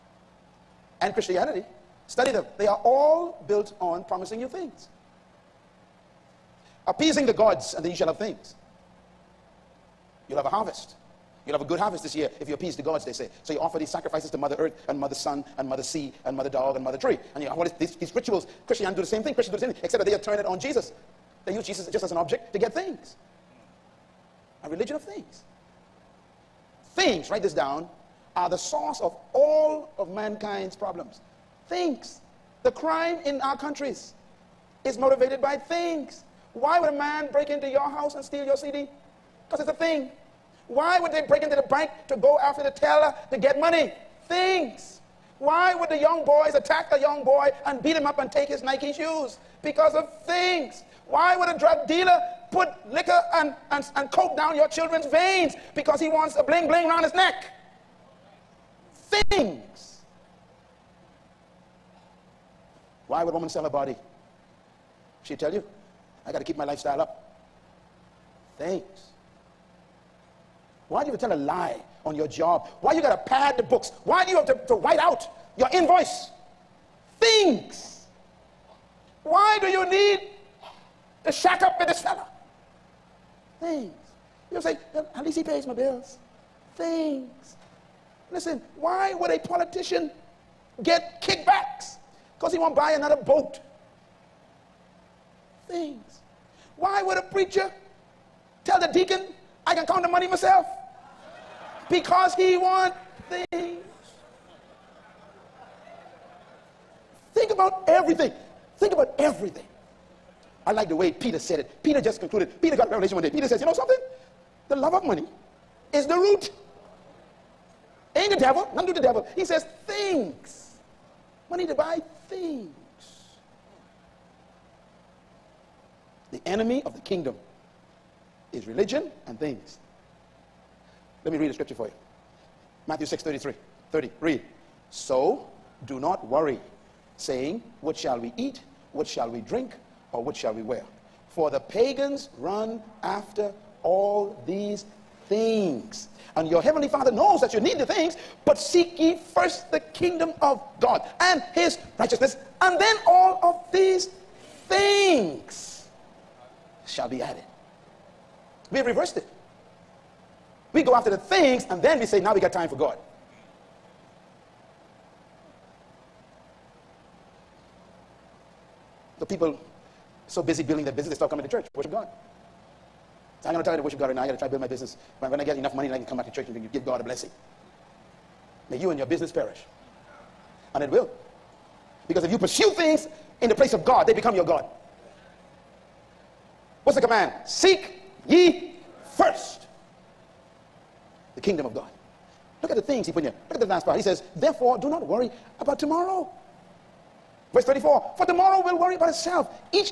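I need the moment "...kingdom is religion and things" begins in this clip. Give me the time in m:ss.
2:06.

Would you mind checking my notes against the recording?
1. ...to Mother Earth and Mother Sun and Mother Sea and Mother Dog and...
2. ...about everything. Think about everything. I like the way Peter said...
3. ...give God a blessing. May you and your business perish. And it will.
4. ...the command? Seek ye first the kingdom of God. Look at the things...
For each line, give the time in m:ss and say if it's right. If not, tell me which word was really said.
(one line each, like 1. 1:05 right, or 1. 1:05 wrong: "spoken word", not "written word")
1. 0:14 right
2. 1:47 right
3. 2:56 right
4. 3:06 right.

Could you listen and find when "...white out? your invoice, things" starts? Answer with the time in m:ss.
1:14.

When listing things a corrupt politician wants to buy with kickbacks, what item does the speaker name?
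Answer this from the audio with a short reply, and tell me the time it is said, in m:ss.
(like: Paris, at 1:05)
boat, at 1:33.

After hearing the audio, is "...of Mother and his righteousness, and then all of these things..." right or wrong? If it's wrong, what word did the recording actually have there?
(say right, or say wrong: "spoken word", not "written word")
wrong: "God", not "Mother".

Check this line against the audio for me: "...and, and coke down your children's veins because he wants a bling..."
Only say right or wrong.
right.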